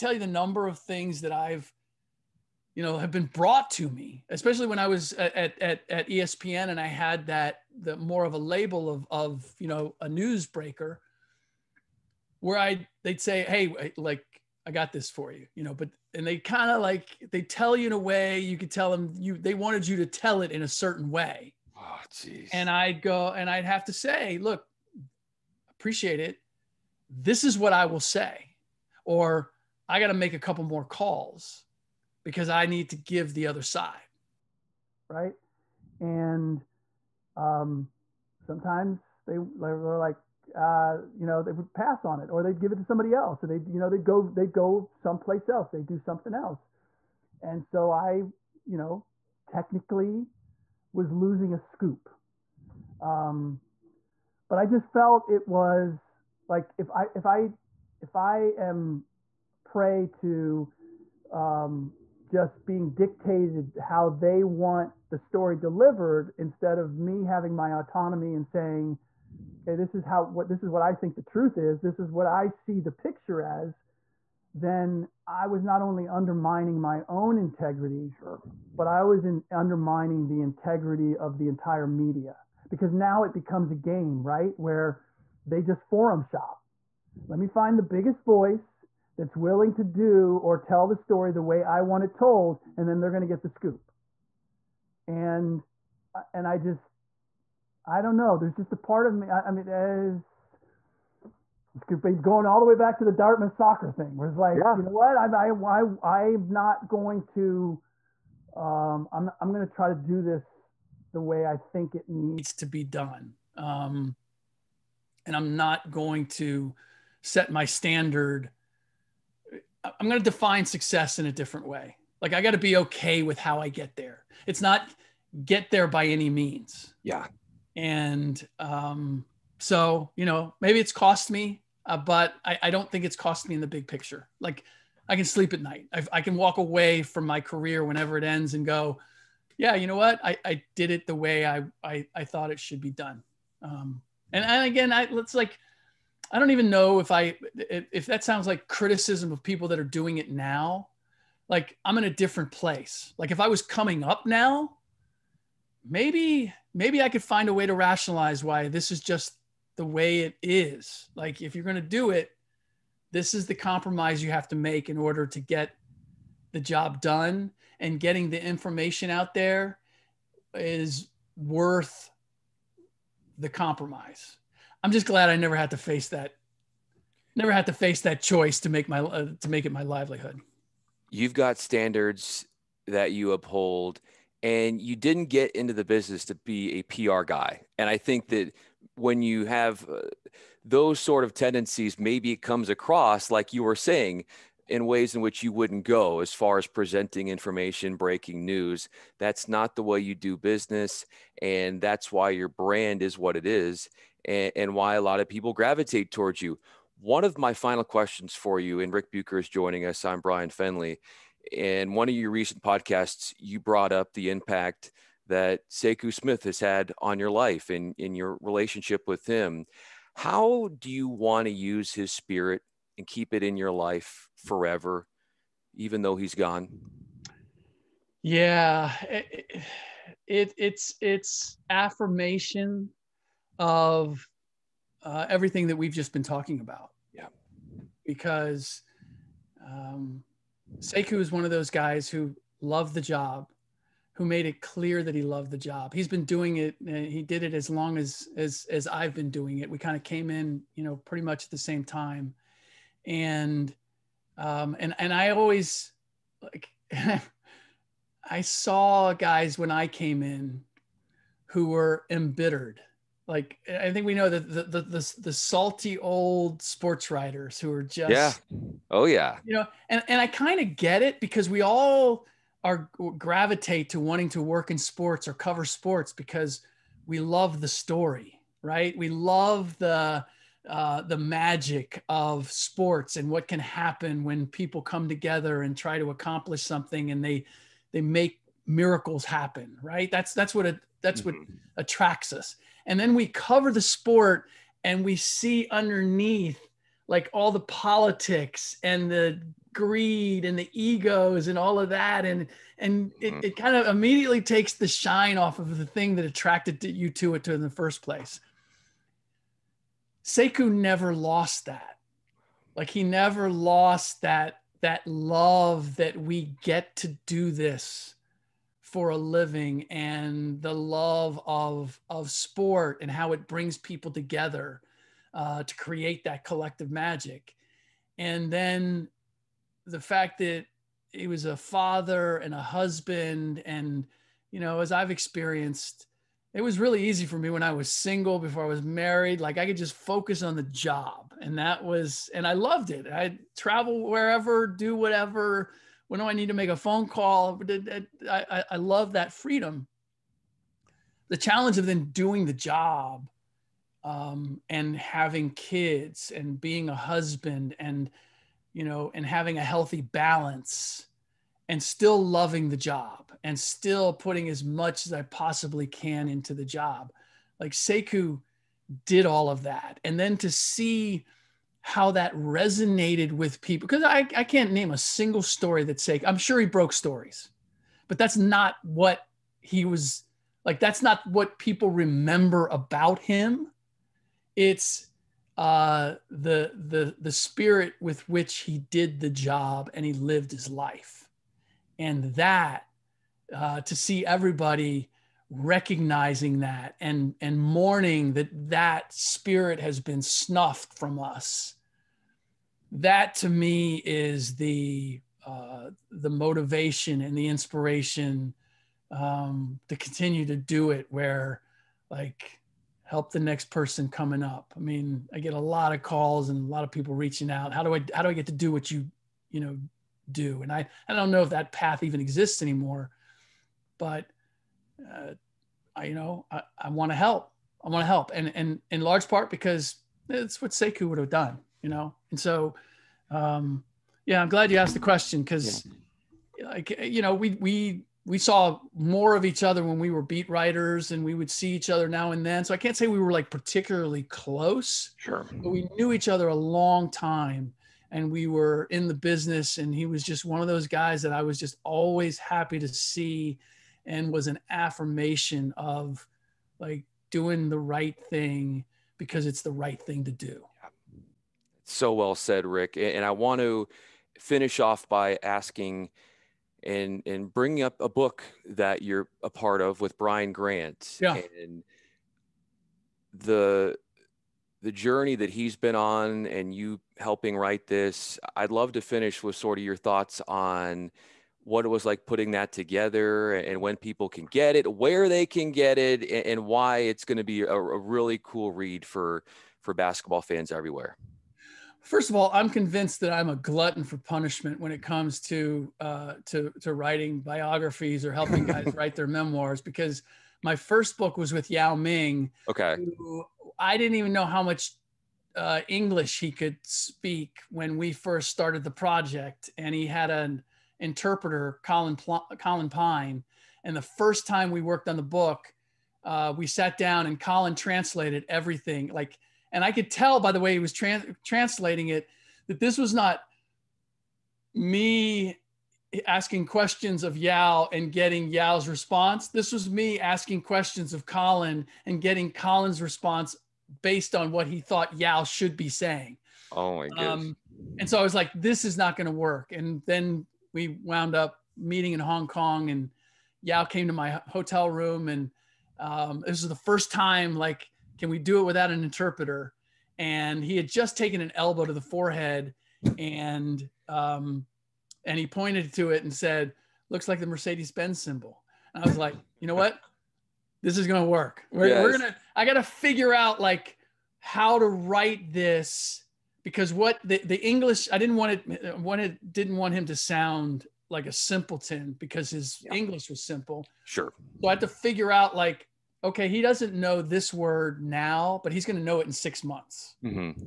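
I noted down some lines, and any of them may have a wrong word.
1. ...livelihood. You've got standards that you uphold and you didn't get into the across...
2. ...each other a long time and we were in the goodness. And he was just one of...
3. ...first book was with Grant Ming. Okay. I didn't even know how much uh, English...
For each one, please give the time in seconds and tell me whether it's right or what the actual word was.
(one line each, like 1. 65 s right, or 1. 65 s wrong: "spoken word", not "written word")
1. 179 s wrong: "business", not "across"
2. 446 s wrong: "business", not "goodness"
3. 500 s wrong: "Yao", not "Grant".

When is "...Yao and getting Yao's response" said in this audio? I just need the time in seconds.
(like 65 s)
527 s.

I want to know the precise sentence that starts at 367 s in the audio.
Like Sekou did all of that.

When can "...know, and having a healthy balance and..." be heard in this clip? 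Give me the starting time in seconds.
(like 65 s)
358 s.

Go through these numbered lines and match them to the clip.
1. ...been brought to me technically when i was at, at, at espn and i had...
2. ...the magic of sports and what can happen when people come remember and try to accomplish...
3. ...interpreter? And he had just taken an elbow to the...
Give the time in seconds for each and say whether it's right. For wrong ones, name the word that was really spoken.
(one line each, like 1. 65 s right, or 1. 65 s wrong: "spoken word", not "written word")
1. 3 s wrong: "especially", not "technically"
2. 281 s wrong: "together", not "remember"
3. 549 s right.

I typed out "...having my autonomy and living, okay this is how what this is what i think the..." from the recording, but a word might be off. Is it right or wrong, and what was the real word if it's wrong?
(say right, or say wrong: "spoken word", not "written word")
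wrong: "saying", not "living".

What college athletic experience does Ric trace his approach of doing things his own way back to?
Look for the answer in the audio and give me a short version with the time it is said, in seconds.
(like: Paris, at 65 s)
Dartmouth soccer, at 103 s.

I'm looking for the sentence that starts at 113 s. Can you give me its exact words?
Um, and I'm not going to set my standard.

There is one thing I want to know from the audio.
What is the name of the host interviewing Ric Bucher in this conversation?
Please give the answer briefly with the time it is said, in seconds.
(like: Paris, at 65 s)
Bryan Fenley, at 210 s.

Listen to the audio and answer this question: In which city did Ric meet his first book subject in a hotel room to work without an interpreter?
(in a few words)
Hong Kong.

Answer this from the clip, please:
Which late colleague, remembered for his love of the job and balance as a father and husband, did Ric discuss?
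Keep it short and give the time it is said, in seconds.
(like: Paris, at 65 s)
Sekou Smith, at 215 s.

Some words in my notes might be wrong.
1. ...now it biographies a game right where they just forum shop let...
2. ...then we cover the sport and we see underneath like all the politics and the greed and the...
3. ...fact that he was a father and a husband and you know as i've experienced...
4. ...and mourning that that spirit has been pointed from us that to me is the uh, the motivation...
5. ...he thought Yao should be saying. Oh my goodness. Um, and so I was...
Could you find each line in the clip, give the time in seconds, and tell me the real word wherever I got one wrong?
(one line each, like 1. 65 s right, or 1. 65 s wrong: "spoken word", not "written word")
1. 82 s wrong: "becomes", not "biographies"
2. 292 s right
3. 330 s right
4. 397 s wrong: "snuffed", not "pointed"
5. 534 s right.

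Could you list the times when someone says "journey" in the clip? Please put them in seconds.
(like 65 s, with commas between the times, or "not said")
474 s.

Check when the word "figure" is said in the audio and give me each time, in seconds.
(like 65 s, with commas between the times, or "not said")
562 s, 574 s.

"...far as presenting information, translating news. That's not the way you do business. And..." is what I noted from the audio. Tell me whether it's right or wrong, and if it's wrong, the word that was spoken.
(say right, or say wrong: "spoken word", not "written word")
wrong: "breaking", not "translating".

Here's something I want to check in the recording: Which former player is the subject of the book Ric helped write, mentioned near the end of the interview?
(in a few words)
Brian Grant.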